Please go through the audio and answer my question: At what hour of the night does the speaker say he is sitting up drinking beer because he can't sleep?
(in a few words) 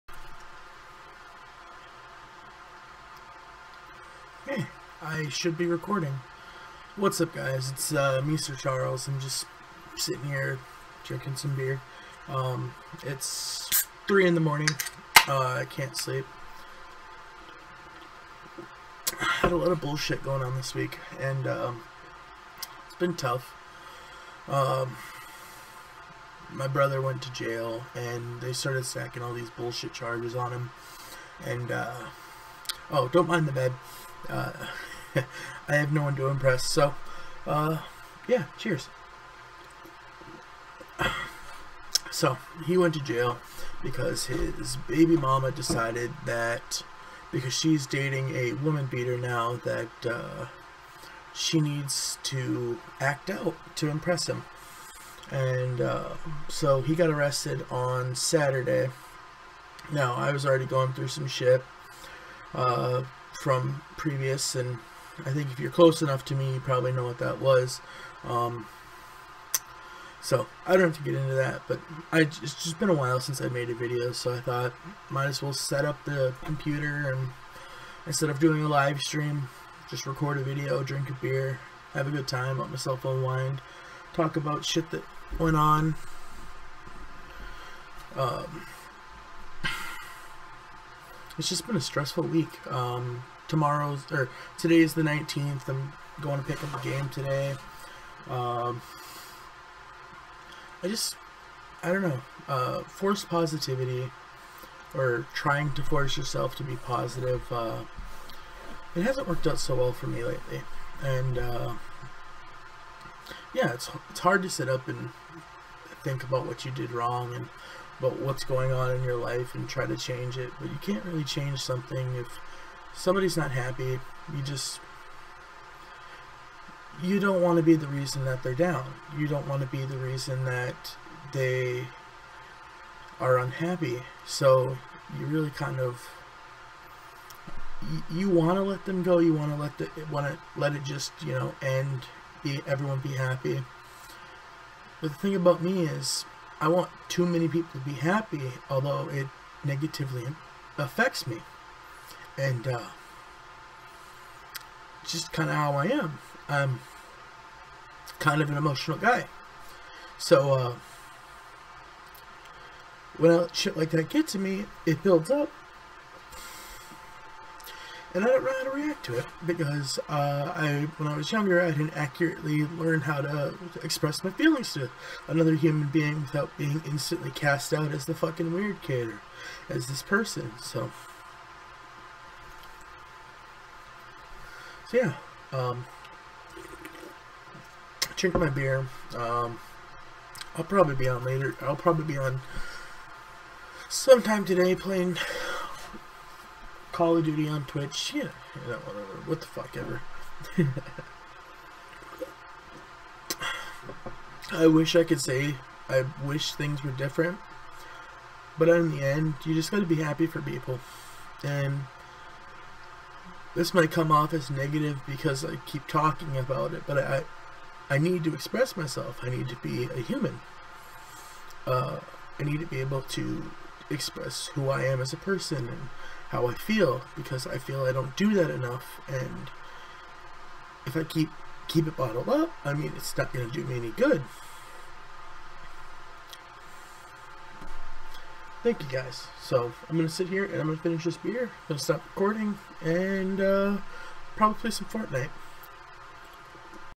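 3 in the morning.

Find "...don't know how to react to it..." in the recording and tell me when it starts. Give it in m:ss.
2:48.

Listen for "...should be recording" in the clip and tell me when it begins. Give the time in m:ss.
0:05.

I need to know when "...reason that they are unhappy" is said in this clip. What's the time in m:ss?
2:09.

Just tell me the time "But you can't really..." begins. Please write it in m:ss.
2:00.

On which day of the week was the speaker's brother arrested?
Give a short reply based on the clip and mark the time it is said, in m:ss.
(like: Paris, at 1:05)
Saturday, at 0:58.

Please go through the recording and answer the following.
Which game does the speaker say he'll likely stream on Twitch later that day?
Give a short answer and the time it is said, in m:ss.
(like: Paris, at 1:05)
Call of Duty, at 3:16.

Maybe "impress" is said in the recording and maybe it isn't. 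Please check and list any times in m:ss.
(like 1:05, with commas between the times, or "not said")
0:36, 0:53.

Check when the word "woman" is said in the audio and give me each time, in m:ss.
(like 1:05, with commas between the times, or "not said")
0:48.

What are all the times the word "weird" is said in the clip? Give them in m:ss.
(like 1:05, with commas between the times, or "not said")
2:58.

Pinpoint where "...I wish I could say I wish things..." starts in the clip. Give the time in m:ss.
3:24.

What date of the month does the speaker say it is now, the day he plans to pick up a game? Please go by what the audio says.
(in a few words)
19th.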